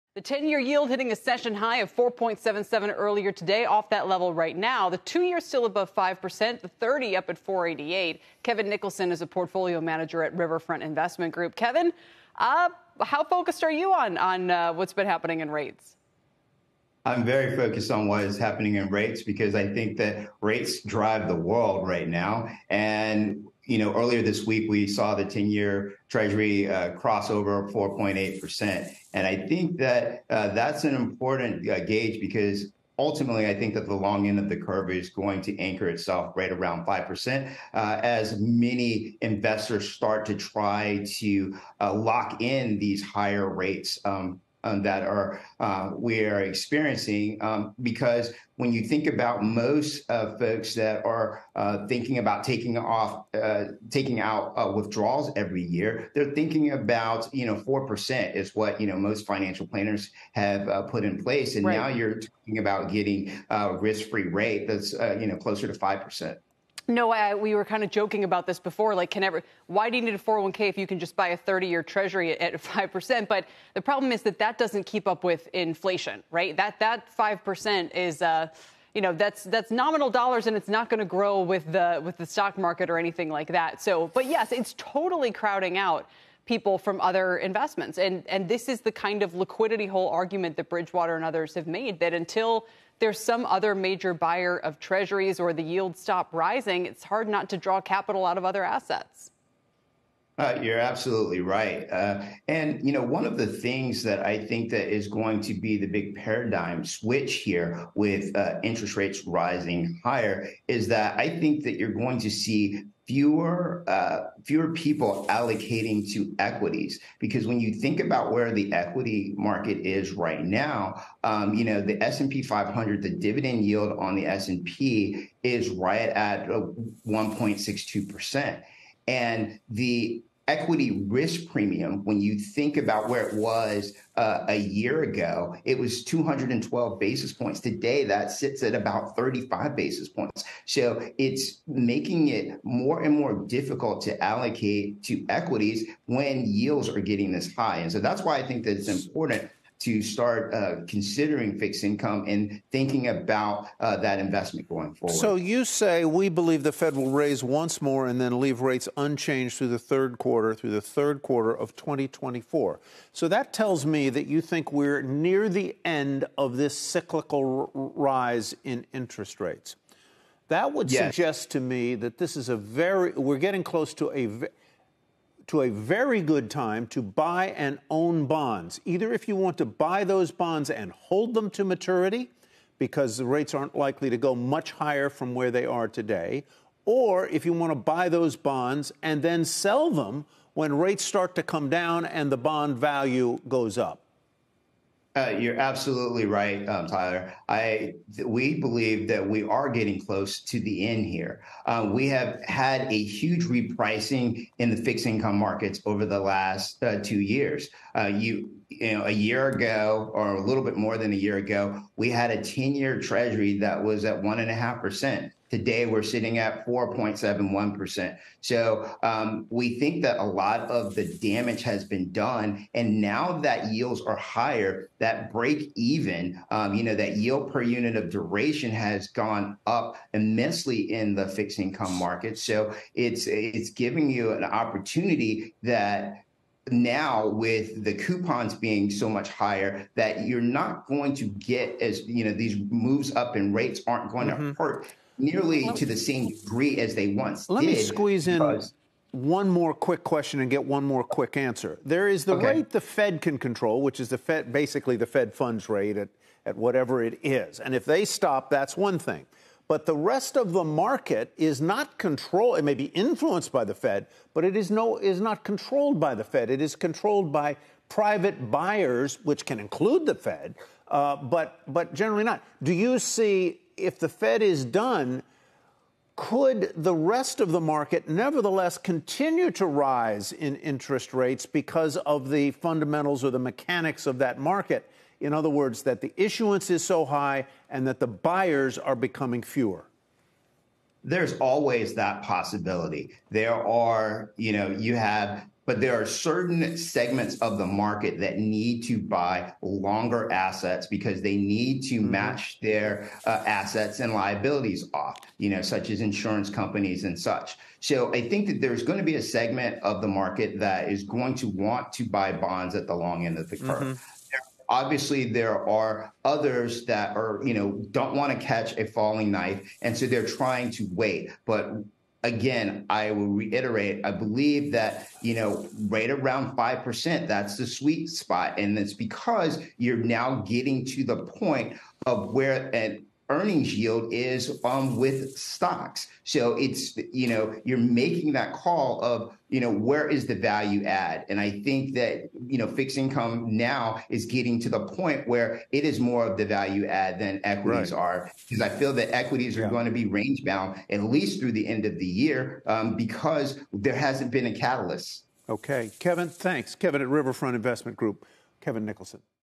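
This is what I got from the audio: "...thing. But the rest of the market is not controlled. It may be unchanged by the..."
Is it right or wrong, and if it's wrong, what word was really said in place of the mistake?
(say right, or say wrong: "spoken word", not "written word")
wrong: "influenced", not "unchanged".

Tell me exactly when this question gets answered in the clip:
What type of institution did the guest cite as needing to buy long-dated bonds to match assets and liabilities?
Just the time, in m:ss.
5:06.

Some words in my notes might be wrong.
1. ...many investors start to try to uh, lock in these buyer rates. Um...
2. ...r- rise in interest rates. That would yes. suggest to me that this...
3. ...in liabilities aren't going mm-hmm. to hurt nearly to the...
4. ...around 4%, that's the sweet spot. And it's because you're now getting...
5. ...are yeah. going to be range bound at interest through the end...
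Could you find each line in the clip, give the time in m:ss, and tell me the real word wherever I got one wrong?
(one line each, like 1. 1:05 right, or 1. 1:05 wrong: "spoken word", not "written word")
1. 0:38 wrong: "higher", not "buyer"
2. 2:47 right
3. 4:03 wrong: "rates", not "liabilities"
4. 5:26 wrong: "5", not "4"
5. 5:49 wrong: "least", not "interest".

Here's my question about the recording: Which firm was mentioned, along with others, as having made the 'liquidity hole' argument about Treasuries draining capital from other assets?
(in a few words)
Bridgewater.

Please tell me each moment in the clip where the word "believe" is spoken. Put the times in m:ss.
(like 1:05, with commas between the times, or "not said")
2:36, 3:18, 5:24.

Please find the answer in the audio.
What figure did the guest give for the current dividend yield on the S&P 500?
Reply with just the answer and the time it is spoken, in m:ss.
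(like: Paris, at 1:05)
1.62%, at 2:06.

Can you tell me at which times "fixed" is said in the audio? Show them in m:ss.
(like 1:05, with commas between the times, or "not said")
2:31, 3:24, 3:51, 5:42.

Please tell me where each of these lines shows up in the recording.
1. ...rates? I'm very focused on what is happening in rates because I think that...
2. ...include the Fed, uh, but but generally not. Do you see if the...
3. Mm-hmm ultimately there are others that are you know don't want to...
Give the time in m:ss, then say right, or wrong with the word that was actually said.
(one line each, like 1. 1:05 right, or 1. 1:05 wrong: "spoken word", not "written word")
1. 0:15 right
2. 4:29 right
3. 5:13 wrong: "obviously", not "ultimately".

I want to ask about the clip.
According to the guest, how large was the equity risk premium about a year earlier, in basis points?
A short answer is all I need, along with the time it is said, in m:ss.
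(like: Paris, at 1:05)
212, at 2:16.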